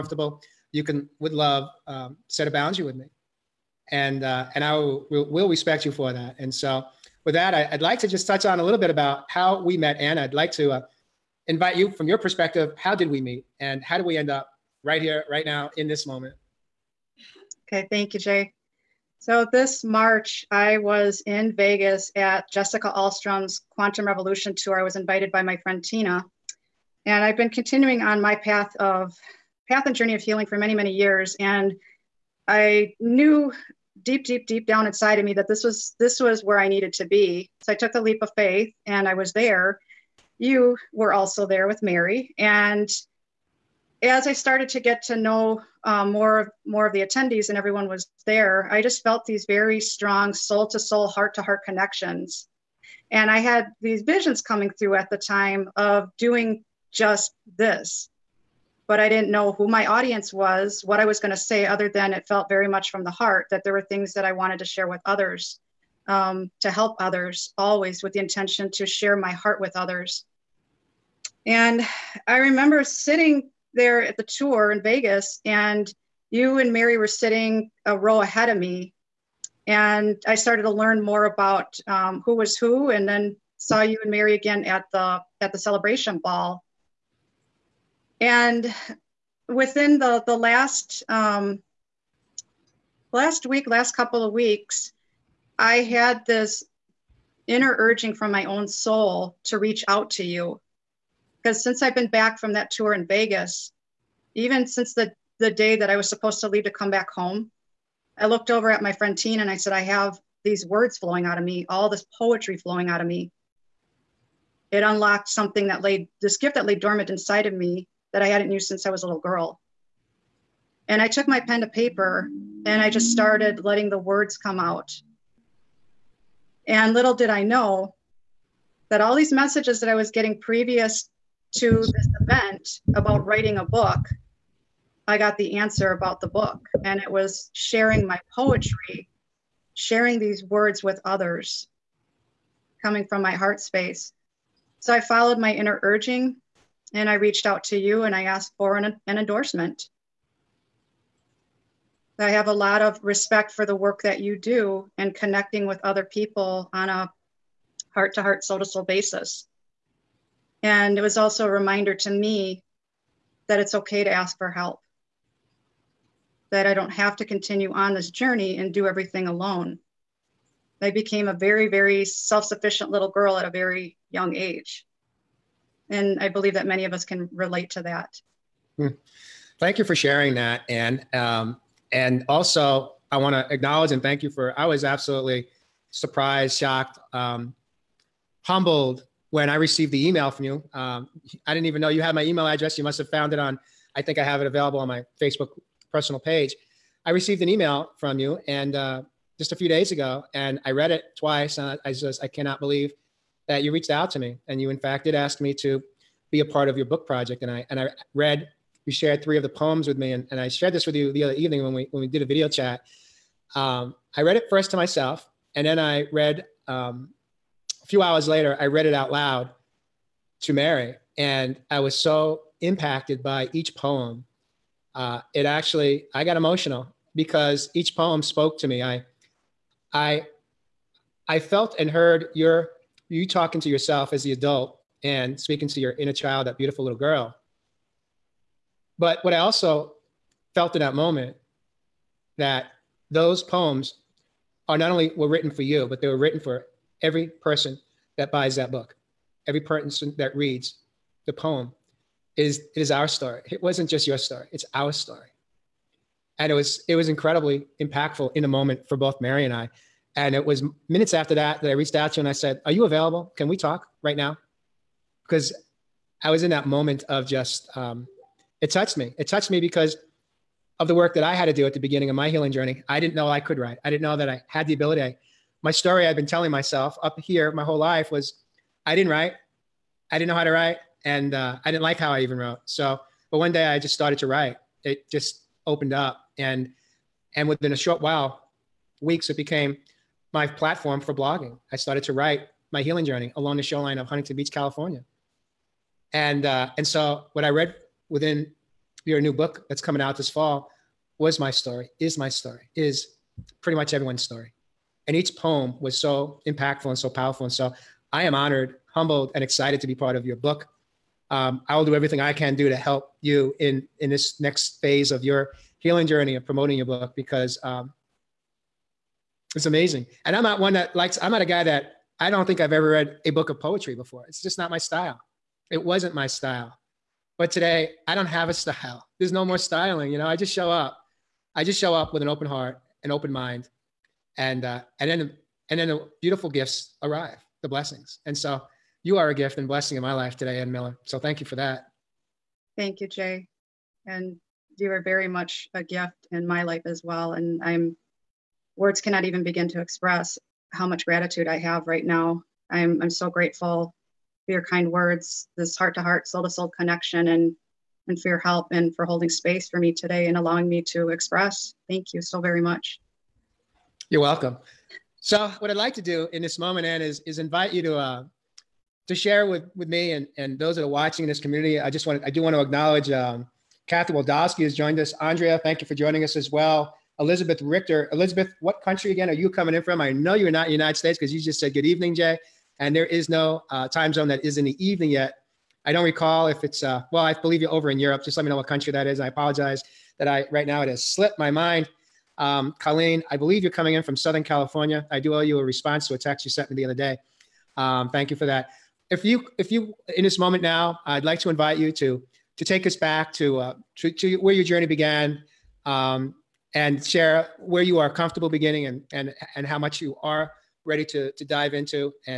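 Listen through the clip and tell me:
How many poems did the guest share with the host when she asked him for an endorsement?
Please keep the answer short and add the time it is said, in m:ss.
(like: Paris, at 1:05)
3, at 3:29.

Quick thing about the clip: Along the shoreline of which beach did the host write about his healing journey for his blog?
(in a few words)
Huntington Beach.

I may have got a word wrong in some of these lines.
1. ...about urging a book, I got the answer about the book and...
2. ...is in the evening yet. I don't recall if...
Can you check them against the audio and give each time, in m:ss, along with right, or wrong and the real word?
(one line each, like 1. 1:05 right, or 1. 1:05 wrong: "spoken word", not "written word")
1. 2:12 wrong: "writing", not "urging"
2. 6:24 right.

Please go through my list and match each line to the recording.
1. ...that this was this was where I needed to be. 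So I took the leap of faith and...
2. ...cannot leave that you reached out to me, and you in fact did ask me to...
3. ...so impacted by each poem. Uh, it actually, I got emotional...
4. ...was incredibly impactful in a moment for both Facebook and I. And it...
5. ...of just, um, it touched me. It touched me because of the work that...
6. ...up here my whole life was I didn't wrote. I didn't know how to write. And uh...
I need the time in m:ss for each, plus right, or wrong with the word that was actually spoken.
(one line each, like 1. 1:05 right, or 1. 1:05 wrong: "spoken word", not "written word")
1. 0:35 right
2. 3:22 wrong: "believe", not "leave"
3. 3:41 right
4. 4:16 wrong: "Mary", not "Facebook"
5. 4:27 right
6. 4:37 wrong: "write", not "wrote".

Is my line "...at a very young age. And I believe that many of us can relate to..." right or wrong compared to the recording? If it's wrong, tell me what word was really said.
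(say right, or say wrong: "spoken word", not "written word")
right.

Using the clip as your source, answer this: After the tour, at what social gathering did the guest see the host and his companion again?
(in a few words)
celebration ball.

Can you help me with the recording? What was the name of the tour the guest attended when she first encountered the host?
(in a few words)
Quantum Revolution tour.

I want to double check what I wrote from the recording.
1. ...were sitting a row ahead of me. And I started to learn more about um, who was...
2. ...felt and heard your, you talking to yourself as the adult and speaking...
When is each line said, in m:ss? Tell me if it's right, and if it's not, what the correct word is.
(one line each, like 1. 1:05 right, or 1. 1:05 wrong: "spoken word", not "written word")
1. 1:16 right
2. 3:51 right.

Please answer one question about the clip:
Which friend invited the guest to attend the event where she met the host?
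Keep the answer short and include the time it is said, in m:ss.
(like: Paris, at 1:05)
Tina, at 0:25.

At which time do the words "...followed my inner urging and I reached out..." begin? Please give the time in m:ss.
2:24.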